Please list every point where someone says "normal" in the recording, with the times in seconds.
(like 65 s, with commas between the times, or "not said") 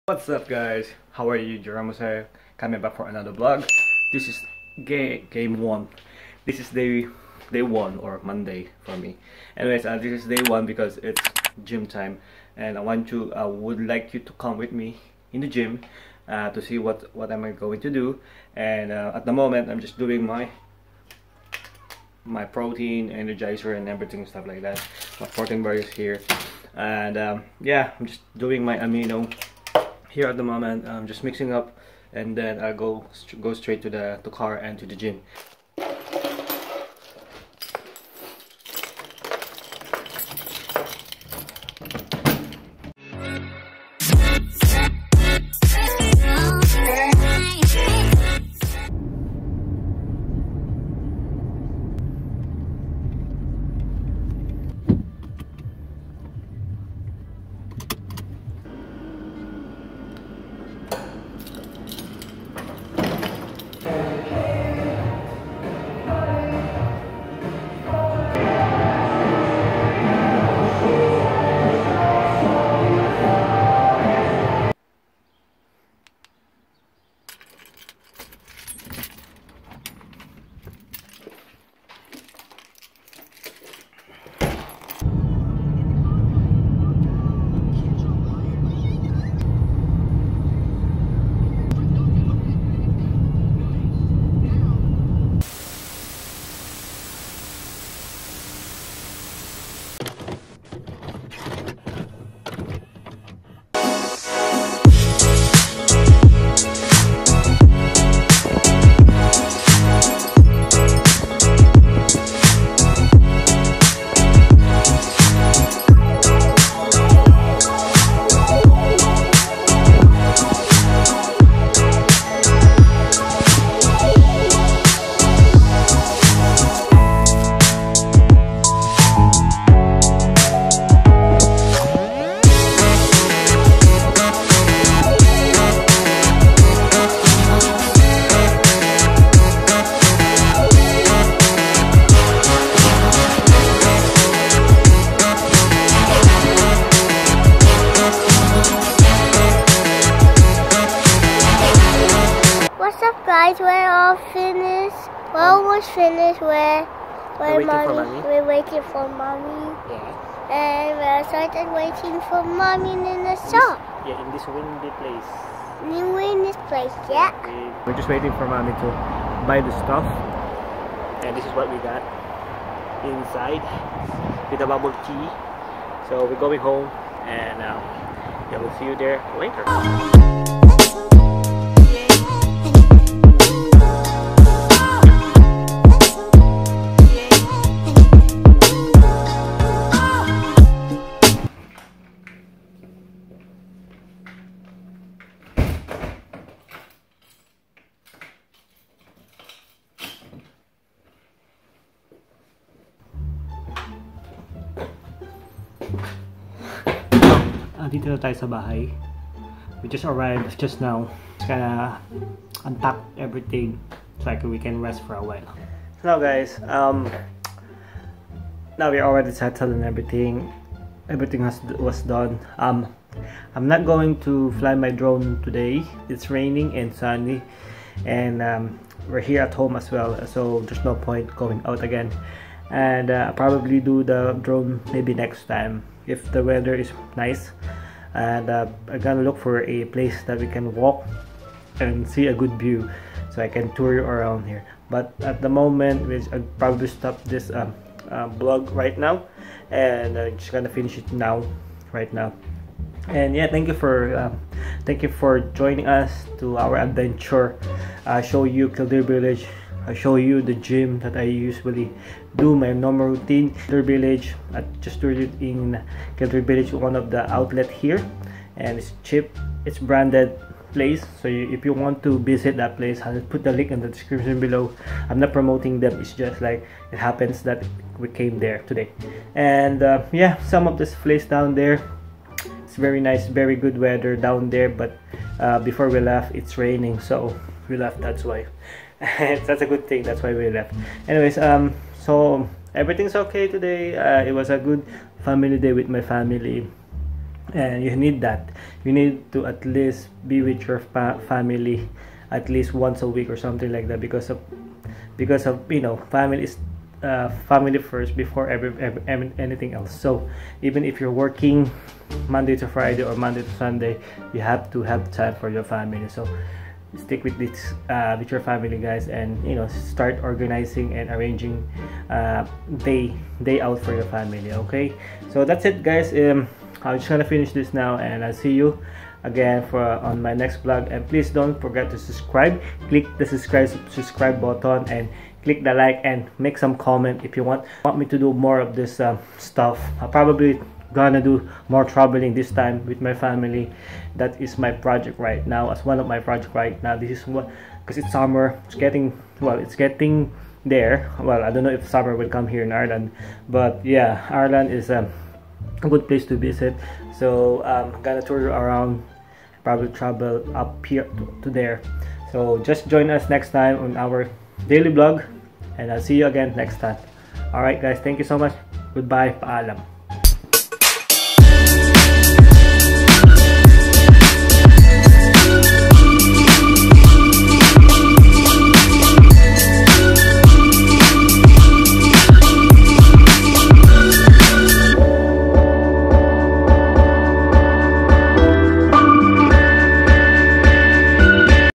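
262 s.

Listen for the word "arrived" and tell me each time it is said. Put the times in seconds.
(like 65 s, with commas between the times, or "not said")
210 s.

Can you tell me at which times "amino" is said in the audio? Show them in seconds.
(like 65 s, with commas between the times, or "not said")
28 s.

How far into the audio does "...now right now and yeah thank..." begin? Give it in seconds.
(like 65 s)
251 s.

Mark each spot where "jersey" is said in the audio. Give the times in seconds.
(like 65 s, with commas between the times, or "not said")
not said.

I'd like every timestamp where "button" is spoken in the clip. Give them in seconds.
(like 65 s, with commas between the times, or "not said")
334 s.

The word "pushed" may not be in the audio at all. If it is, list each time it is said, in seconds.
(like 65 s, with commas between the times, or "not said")
not said.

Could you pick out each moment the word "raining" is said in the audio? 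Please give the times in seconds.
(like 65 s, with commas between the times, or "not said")
226 s, 286 s.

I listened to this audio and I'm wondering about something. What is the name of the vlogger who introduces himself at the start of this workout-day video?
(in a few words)
Jerome.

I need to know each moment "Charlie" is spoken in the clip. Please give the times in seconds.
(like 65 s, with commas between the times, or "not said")
not said.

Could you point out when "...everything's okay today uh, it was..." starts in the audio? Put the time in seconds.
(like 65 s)
292 s.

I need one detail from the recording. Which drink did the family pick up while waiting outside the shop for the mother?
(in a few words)
bubble tea.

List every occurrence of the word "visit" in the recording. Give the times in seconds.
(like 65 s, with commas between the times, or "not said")
272 s, 356 s.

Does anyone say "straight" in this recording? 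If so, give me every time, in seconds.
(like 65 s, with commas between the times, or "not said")
33 s.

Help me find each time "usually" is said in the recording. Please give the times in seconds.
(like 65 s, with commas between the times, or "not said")
261 s.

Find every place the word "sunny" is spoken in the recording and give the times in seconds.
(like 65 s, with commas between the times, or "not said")
226 s.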